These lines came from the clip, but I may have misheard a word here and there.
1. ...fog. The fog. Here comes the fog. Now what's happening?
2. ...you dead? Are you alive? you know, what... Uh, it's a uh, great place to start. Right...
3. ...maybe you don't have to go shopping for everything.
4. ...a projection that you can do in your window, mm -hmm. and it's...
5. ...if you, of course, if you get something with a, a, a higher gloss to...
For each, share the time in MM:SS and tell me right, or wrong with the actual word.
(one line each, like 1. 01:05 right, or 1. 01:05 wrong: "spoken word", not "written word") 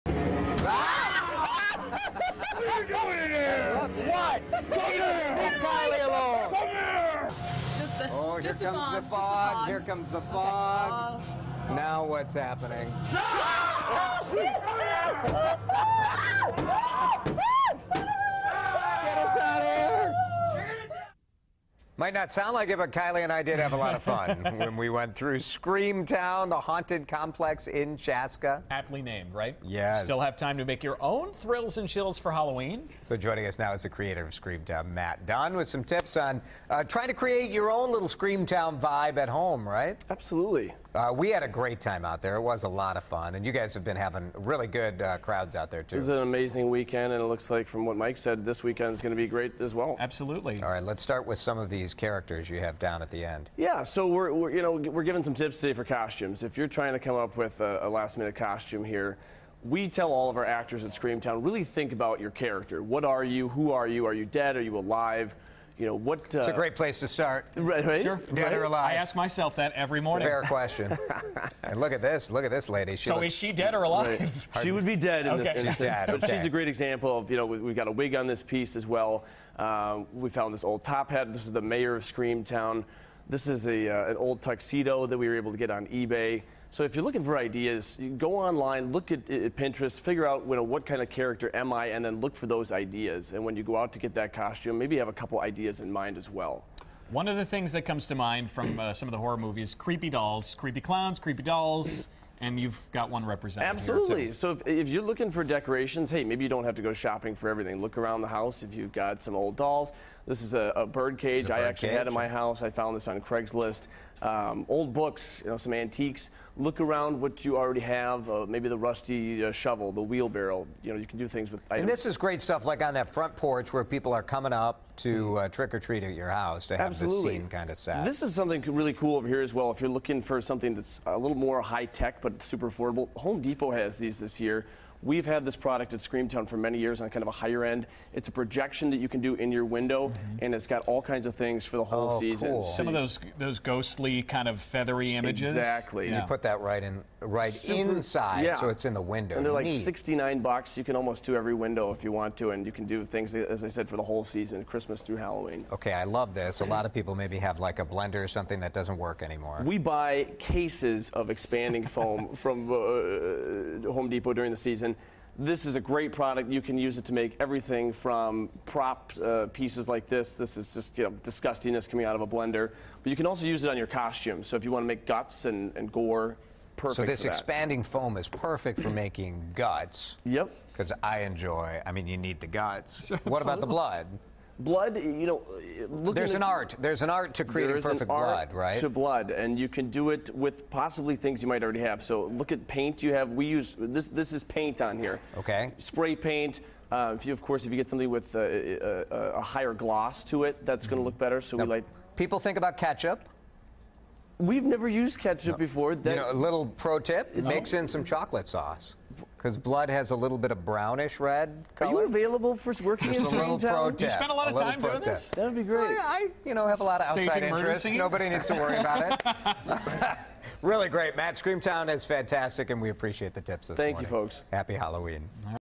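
1. 00:09 right
2. 01:04 right
3. 01:46 right
4. 02:18 right
5. 03:17 right.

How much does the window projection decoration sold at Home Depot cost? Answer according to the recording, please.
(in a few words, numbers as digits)
$69.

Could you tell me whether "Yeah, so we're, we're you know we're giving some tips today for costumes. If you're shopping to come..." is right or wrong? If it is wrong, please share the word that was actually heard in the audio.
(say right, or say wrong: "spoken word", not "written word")
wrong: "trying", not "shopping".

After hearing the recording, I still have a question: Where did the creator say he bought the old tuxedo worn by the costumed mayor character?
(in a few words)
eBay.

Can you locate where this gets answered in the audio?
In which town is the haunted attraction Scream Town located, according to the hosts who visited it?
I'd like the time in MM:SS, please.
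00:27.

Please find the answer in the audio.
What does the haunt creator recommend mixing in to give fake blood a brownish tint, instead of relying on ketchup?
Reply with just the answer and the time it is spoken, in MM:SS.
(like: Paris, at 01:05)
chocolate sauce, at 03:28.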